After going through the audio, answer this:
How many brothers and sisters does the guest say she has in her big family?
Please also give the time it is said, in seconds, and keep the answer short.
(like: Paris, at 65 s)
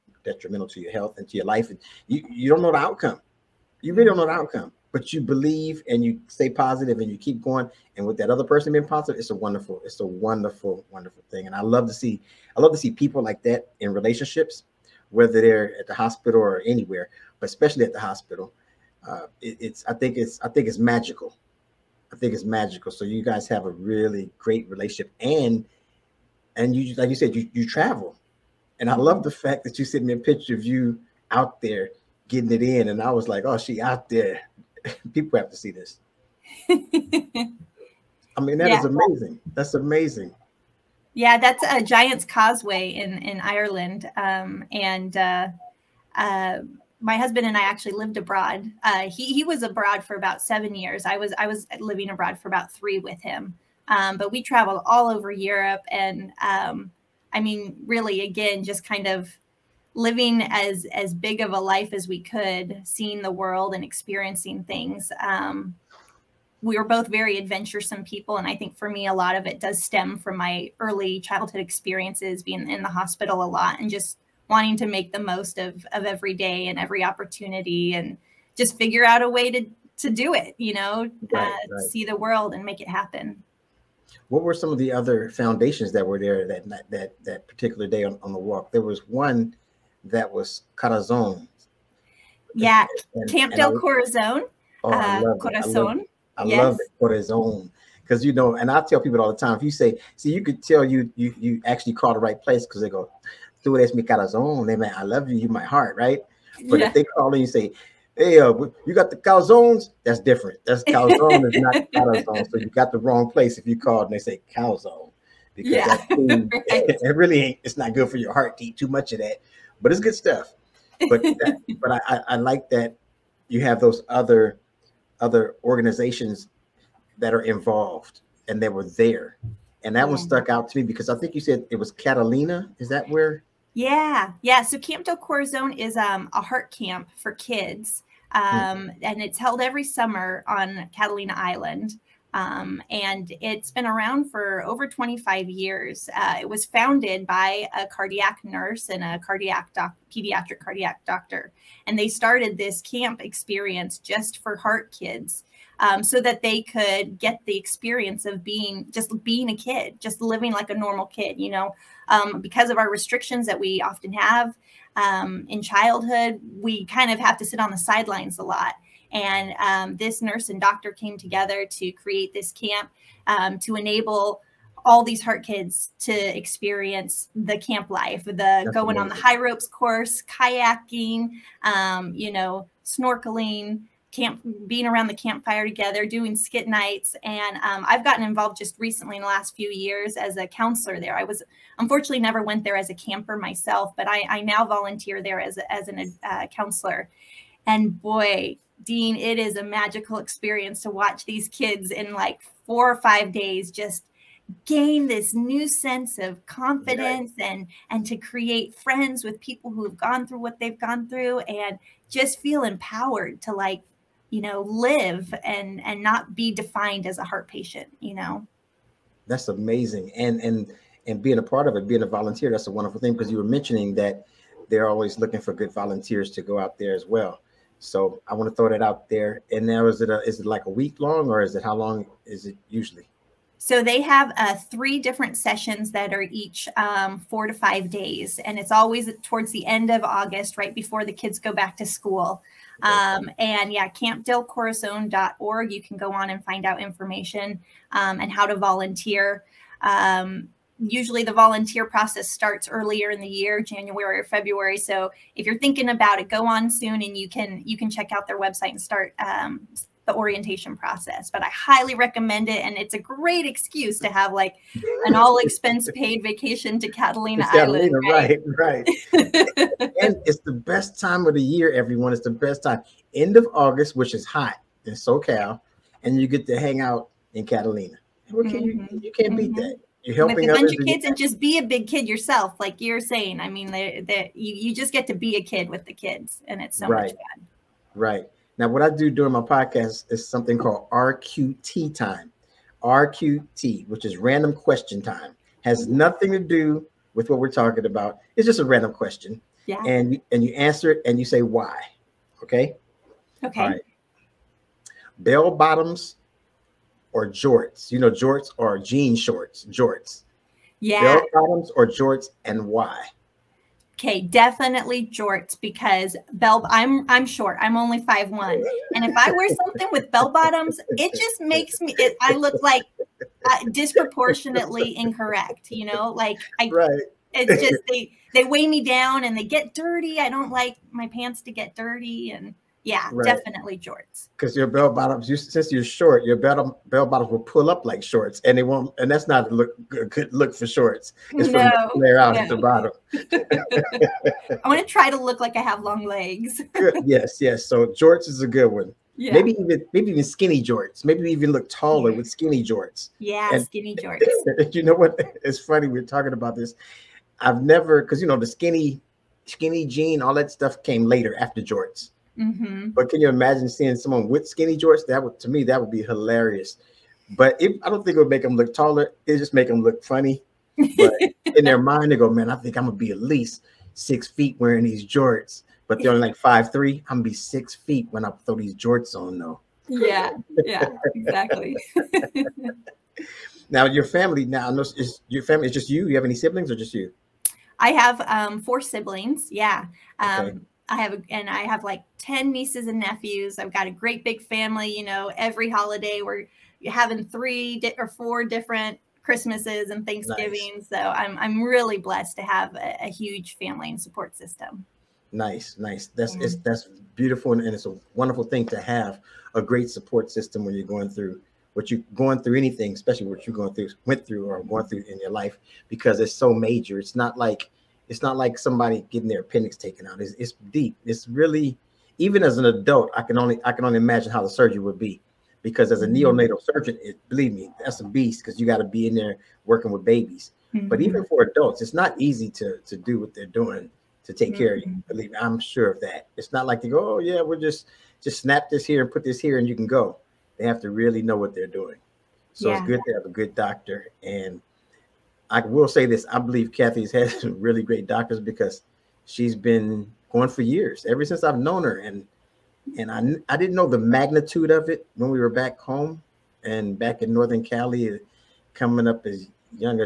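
4, at 388 s.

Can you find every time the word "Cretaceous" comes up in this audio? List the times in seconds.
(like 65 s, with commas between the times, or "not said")
not said.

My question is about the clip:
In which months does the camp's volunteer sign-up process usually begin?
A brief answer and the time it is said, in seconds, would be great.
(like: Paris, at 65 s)
January or February, at 253 s.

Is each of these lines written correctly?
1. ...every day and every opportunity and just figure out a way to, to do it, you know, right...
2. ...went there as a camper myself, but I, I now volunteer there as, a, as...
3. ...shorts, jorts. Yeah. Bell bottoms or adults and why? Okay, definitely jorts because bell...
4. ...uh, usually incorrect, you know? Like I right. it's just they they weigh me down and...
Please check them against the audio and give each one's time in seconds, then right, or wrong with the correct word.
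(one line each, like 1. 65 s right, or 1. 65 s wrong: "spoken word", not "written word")
1. 76 s right
2. 192 s right
3. 309 s wrong: "jorts", not "adults"
4. 323 s wrong: "disproportionately", not "usually".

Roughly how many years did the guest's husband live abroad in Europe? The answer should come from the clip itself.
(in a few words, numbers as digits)
7 years.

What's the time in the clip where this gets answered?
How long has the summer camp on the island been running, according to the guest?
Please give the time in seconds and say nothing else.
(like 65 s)
144 s.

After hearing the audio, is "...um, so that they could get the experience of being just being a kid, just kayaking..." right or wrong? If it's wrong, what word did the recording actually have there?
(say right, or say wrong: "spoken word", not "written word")
wrong: "living", not "kayaking".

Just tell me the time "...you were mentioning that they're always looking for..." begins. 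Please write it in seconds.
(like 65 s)
223 s.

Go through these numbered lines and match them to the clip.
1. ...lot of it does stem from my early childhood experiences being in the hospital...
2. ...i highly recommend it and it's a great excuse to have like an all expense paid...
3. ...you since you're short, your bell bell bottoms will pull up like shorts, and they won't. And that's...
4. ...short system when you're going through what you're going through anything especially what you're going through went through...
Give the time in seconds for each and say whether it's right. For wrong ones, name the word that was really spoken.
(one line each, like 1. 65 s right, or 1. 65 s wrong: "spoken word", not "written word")
1. 69 s right
2. 261 s right
3. 335 s right
4. 409 s wrong: "support", not "short".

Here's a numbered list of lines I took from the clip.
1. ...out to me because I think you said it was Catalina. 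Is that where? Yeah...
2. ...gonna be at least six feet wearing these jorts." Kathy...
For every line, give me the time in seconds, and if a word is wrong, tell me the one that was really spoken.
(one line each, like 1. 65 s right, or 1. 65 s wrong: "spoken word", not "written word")
1. 130 s right
2. 372 s wrong: "But", not "Kathy".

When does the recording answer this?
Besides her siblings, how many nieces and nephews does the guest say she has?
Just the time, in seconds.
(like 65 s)
392 s.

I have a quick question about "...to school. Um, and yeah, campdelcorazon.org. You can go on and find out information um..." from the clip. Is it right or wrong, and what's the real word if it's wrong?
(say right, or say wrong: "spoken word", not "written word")
right.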